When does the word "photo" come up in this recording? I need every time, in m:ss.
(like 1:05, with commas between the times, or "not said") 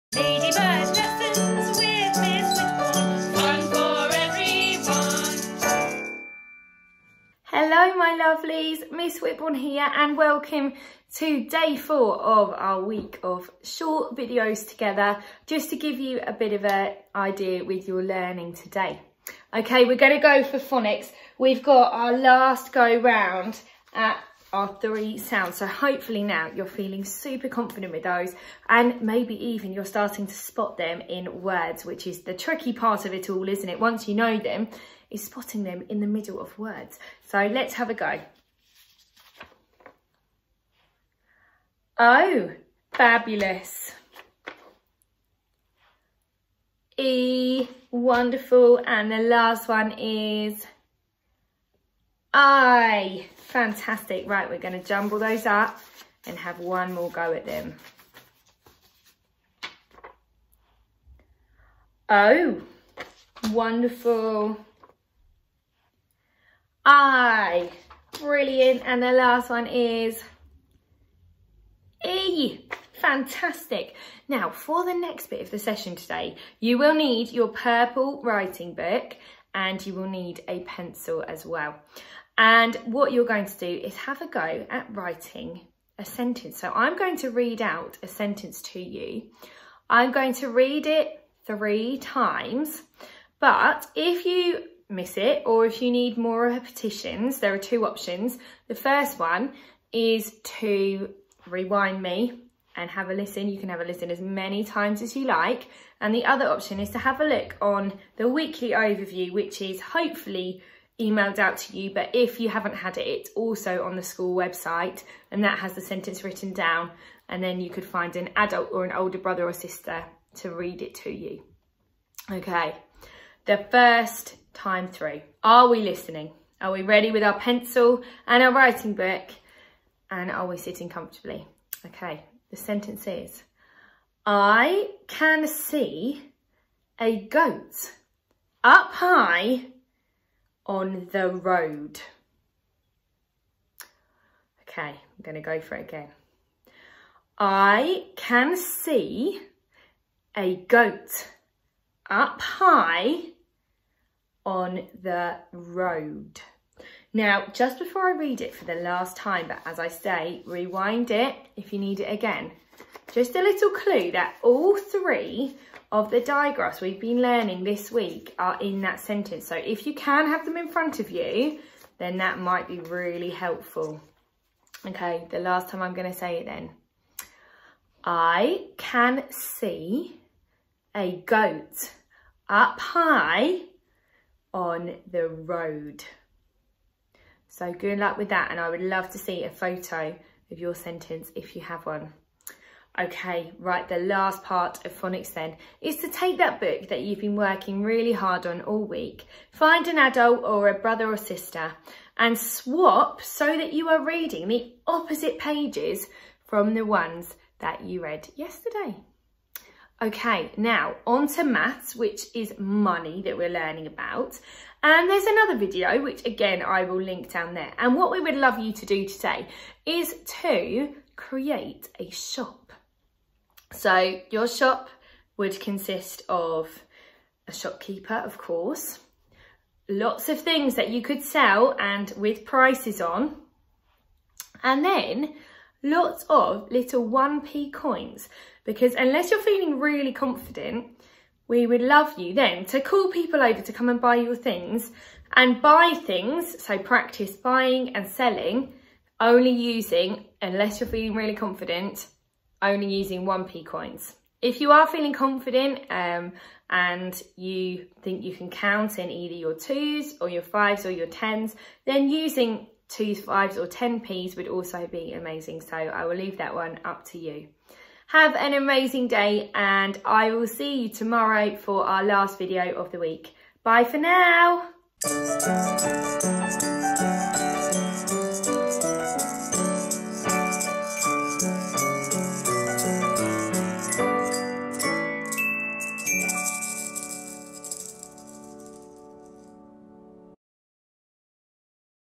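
3:09.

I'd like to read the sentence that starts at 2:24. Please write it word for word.
Okay, I'm going to go for it again.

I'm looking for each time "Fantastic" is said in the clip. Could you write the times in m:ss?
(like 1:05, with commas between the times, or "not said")
0:53, 1:12.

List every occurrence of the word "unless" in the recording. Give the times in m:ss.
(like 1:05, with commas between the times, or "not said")
3:58, 4:10.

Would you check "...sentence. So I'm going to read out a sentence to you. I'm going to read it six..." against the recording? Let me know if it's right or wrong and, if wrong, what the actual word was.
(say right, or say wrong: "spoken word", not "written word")
wrong: "three", not "six".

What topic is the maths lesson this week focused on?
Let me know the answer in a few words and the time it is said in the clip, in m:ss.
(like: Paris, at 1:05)
Money, at 3:32.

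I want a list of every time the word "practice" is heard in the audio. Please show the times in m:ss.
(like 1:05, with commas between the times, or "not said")
4:06.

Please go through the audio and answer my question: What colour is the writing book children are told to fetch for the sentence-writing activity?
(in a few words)
Purple.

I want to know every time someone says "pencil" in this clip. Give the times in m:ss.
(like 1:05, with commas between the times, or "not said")
1:20, 2:07.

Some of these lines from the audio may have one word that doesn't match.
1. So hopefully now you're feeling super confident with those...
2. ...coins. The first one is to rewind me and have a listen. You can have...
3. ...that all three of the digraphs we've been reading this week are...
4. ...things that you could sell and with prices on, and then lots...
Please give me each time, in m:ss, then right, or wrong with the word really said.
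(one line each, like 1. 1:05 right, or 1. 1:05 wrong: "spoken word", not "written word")
1. 0:25 right
2. 1:37 wrong: "options", not "coins"
3. 2:44 wrong: "learning", not "reading"
4. 3:50 right.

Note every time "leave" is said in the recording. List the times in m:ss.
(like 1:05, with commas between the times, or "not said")
4:26.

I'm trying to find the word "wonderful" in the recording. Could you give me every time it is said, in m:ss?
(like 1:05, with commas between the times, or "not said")
0:47, 1:03.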